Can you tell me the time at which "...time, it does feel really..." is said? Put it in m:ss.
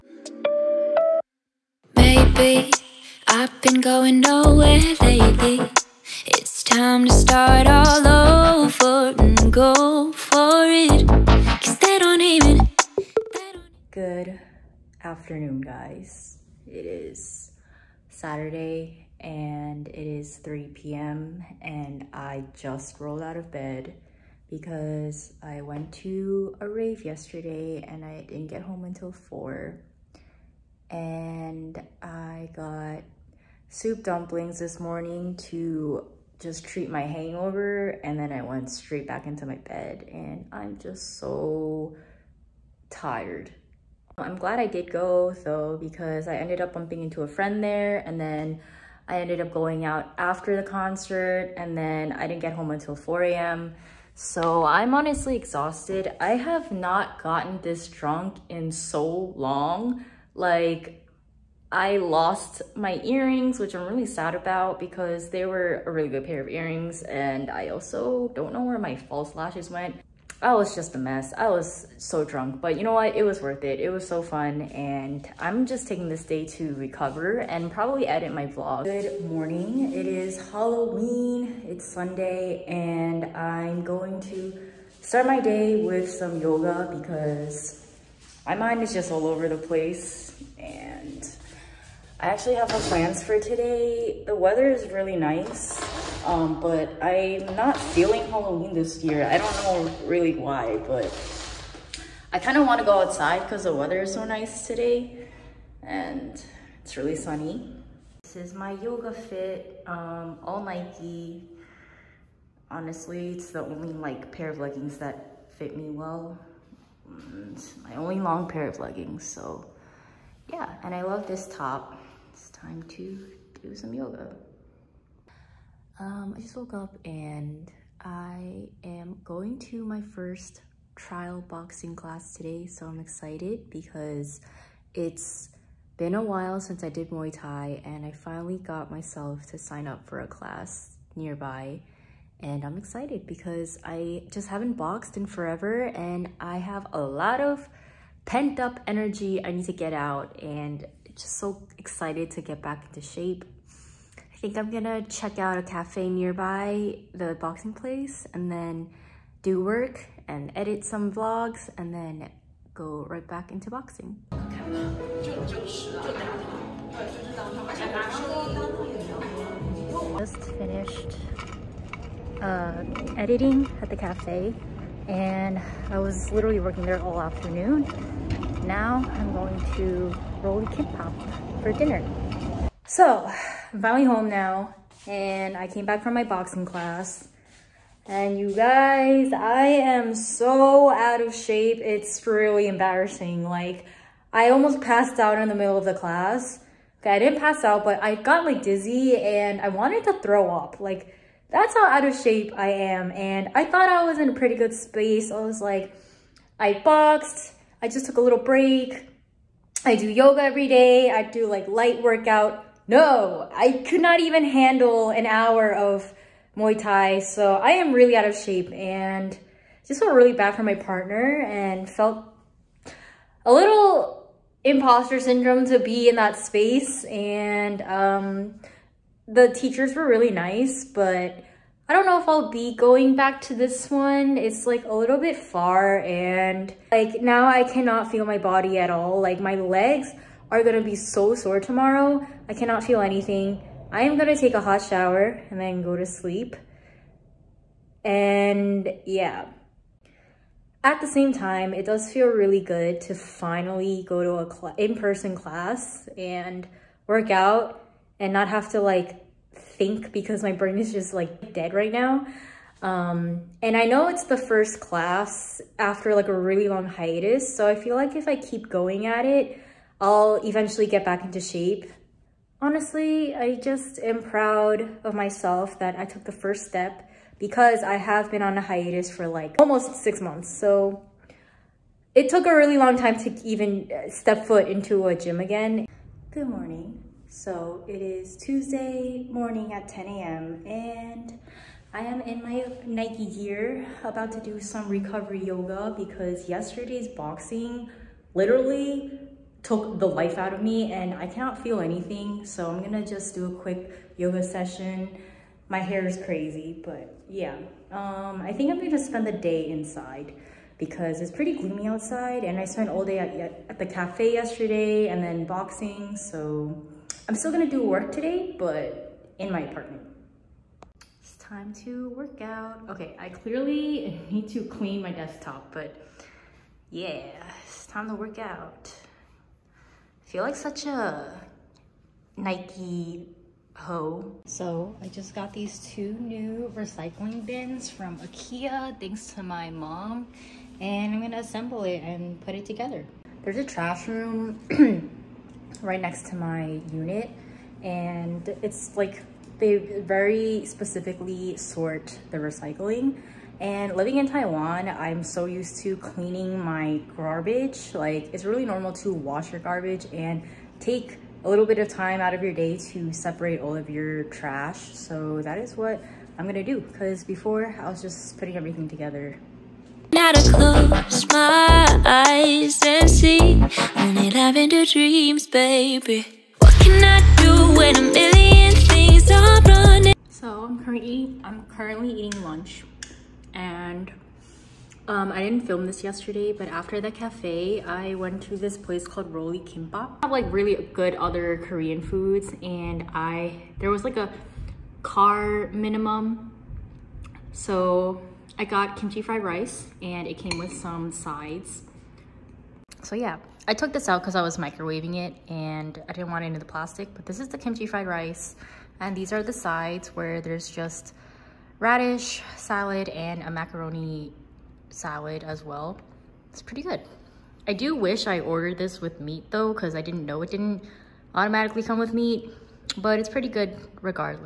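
4:11.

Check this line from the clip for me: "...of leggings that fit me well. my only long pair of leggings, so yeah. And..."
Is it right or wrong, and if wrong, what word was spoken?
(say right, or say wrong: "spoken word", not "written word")
right.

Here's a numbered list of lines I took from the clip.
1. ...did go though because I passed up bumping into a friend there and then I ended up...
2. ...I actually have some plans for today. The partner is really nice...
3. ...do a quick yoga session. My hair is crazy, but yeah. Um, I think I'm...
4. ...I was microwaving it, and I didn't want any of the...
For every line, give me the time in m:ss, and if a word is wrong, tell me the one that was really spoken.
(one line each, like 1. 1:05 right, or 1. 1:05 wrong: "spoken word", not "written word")
1. 0:44 wrong: "ended", not "passed"
2. 1:32 wrong: "weather", not "partner"
3. 5:03 right
4. 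6:44 right.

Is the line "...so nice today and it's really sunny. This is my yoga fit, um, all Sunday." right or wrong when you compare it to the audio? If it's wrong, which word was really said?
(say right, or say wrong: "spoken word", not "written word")
wrong: "Nike", not "Sunday".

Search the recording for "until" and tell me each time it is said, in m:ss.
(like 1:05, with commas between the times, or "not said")
0:28, 0:52.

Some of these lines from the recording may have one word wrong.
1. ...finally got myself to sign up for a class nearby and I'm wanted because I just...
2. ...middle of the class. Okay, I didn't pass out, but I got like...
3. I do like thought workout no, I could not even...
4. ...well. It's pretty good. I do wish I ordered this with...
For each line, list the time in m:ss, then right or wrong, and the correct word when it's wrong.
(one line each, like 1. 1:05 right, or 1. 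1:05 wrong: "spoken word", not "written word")
1. 2:18 wrong: "excited", not "wanted"
2. 3:15 right
3. 3:31 wrong: "light", not "thought"
4. 6:55 right.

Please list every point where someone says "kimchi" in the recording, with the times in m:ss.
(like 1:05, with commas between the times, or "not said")
6:38, 6:47.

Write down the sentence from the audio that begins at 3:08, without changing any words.
And you guys, I am so out of shape.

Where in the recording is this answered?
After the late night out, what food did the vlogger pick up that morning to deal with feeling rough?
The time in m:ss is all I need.
0:33.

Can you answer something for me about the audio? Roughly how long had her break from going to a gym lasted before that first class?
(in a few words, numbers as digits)
Almost six months.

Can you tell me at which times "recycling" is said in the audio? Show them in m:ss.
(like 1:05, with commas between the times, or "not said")
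5:36, 5:52.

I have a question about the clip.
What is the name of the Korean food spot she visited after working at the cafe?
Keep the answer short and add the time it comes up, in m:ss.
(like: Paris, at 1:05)
Roly Kimbap, at 6:29.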